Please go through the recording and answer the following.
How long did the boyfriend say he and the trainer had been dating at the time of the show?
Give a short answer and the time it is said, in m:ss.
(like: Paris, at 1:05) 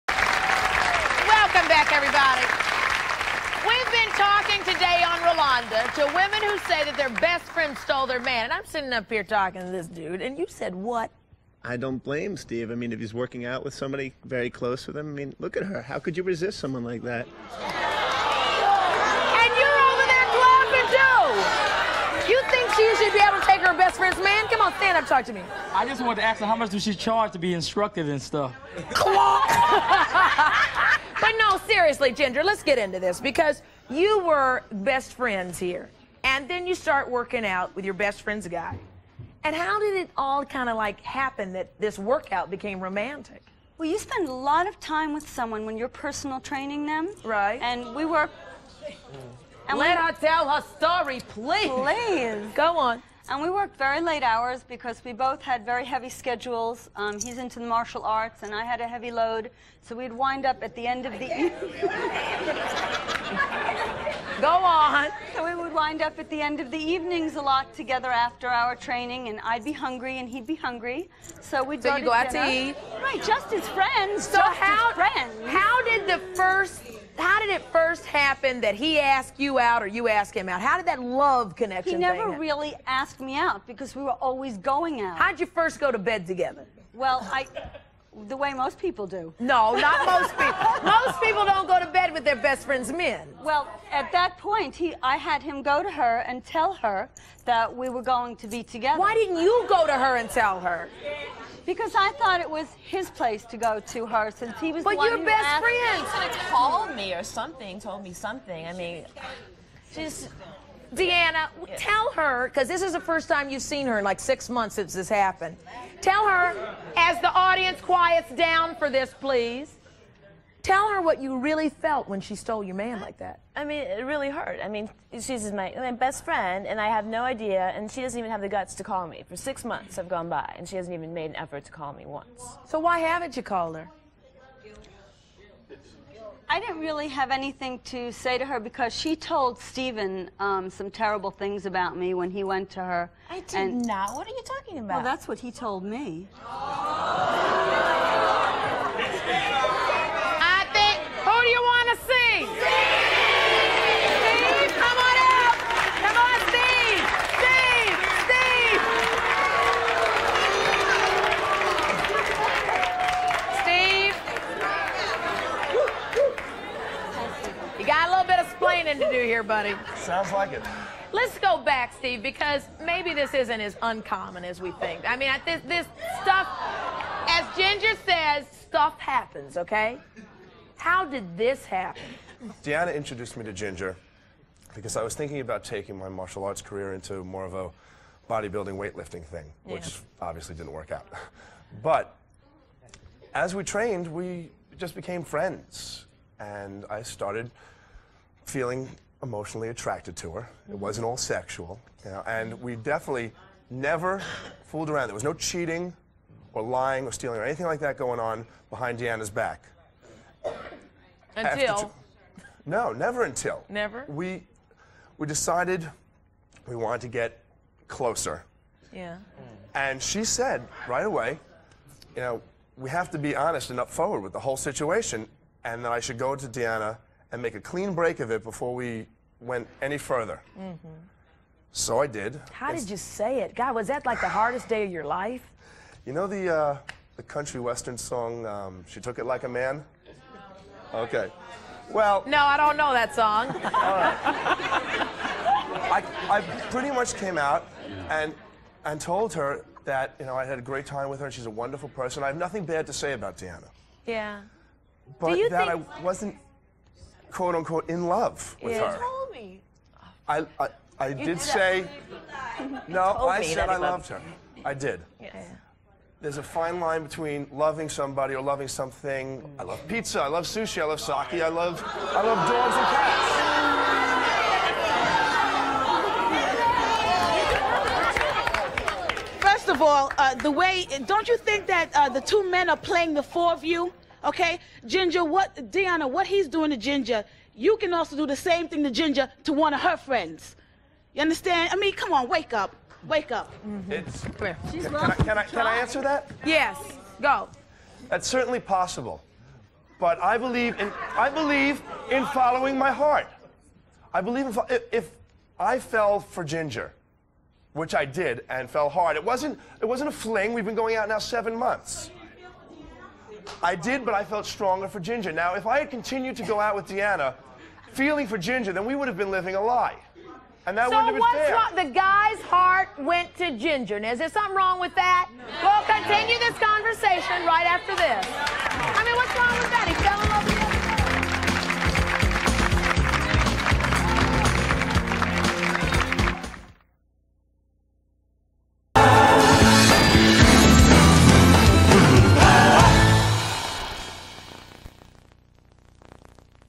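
7 months, at 5:11.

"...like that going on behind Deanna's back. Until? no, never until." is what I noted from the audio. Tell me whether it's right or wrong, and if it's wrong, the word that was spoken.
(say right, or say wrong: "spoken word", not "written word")
right.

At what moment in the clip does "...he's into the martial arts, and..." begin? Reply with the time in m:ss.
0:57.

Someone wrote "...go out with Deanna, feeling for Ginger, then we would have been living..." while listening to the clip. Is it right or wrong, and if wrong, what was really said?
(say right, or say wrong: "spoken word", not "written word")
right.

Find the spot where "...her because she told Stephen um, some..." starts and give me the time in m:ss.
2:18.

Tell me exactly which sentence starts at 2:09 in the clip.
For six months have gone by, and she hasn't even made an effort to call me once.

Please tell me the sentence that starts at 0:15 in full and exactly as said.
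How could you resist someone like that?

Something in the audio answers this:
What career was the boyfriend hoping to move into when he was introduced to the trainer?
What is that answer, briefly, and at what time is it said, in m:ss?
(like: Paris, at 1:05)
bodybuilding weightlifting, at 3:08.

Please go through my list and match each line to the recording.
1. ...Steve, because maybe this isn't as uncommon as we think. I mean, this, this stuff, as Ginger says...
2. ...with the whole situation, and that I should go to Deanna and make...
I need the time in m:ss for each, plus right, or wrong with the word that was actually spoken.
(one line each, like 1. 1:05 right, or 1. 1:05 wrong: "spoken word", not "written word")
1. 2:51 right
2. 3:44 right.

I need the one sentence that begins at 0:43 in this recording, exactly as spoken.
Well, you spend a lot of time with someone when you're personal training them.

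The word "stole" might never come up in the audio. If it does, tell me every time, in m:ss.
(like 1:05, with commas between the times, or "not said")
0:07, 2:02.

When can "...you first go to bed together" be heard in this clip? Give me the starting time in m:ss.
1:25.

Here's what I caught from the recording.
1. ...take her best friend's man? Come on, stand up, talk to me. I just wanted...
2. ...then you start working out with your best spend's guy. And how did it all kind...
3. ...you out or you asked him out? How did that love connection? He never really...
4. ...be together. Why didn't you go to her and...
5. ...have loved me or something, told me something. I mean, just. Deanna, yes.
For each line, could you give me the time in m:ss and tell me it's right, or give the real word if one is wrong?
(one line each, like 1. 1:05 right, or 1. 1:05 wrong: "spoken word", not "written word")
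1. 0:23 right
2. 0:36 wrong: "friend", not "spend"
3. 1:19 right
4. 1:38 right
5. 1:46 wrong: "called", not "loved".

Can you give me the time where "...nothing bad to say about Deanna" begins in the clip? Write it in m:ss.
4:12.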